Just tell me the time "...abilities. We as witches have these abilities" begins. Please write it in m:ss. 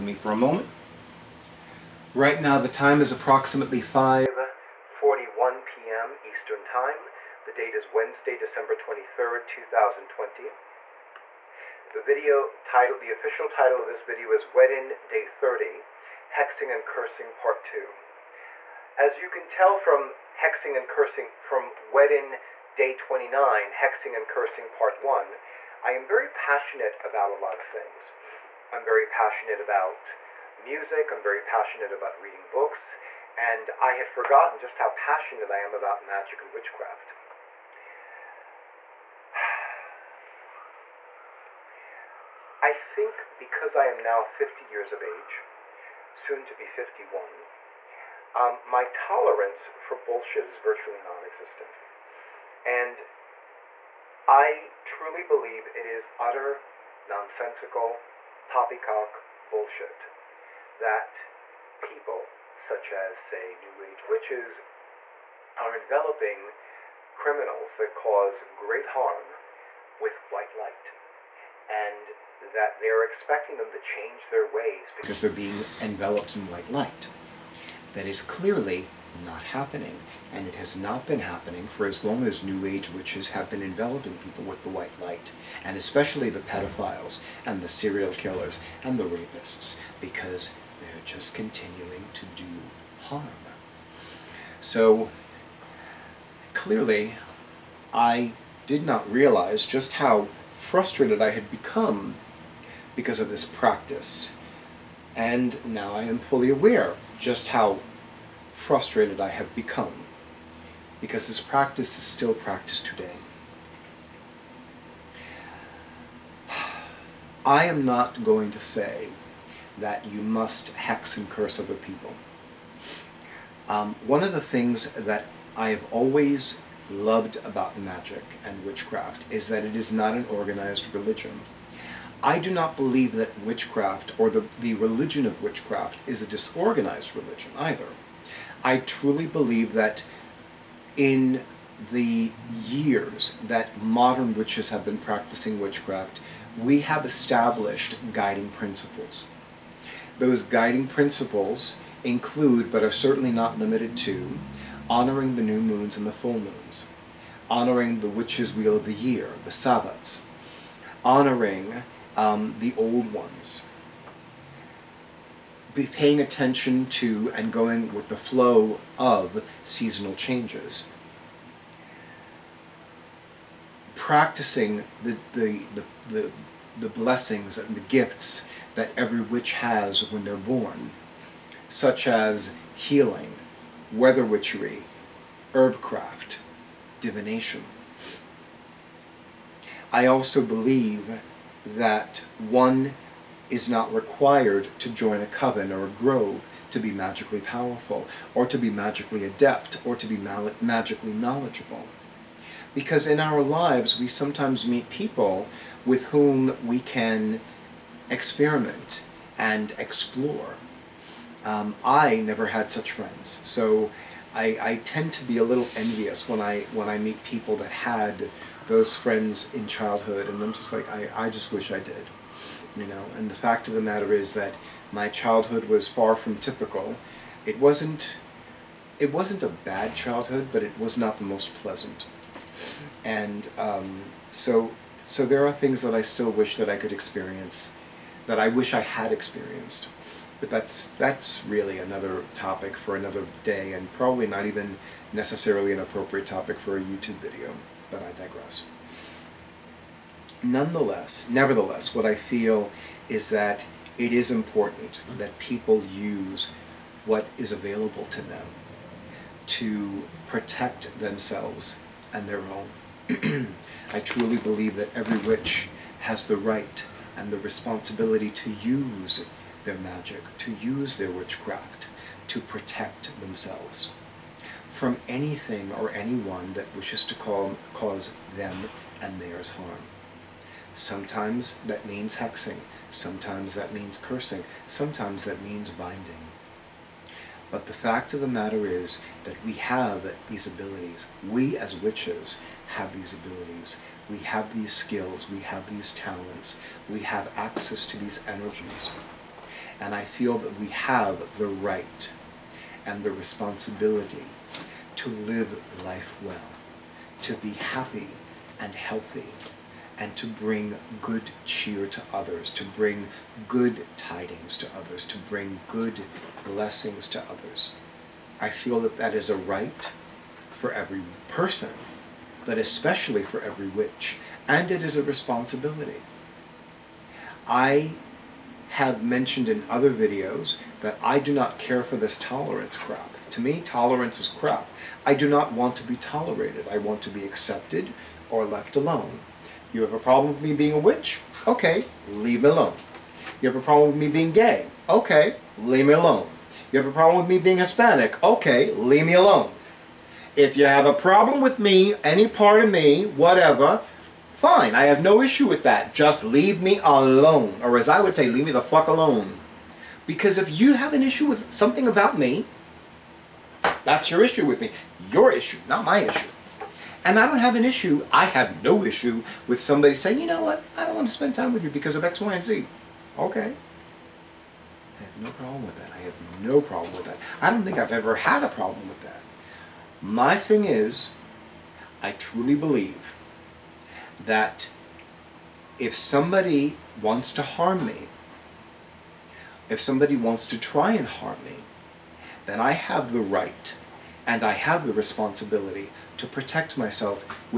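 4:50.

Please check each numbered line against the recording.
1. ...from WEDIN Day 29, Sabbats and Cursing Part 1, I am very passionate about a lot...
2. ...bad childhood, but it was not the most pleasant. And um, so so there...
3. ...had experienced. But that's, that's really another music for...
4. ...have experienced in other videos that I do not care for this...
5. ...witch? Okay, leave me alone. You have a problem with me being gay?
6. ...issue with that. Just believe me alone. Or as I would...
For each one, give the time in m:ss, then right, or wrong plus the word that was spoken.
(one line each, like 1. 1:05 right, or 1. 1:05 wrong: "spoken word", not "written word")
1. 0:21 wrong: "Hexing", not "Sabbats"
2. 3:49 right
3. 3:58 wrong: "topic", not "music"
4. 5:28 wrong: "mentioned", not "experienced"
5. 5:40 right
6. 5:55 wrong: "leave", not "believe".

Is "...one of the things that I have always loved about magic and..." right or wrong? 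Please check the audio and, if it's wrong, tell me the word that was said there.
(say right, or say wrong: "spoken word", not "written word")
right.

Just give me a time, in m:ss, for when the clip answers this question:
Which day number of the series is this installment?
0:15.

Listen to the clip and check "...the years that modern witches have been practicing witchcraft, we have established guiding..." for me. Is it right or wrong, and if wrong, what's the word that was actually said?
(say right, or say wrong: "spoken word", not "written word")
right.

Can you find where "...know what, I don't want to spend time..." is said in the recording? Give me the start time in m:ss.
6:10.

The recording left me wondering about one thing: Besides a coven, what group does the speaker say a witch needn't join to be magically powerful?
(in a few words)
A grove.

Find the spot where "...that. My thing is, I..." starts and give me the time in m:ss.
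6:19.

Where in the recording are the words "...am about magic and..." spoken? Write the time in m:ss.
0:35.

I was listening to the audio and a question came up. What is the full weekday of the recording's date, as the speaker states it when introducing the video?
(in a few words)
Wednesday.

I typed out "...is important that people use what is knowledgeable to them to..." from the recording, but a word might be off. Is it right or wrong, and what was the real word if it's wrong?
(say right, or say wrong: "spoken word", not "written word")
wrong: "available", not "knowledgeable".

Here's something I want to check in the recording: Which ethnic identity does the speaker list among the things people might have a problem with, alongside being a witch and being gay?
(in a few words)
Hispanic.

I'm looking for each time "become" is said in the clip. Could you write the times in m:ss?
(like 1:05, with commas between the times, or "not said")
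1:41, 1:49.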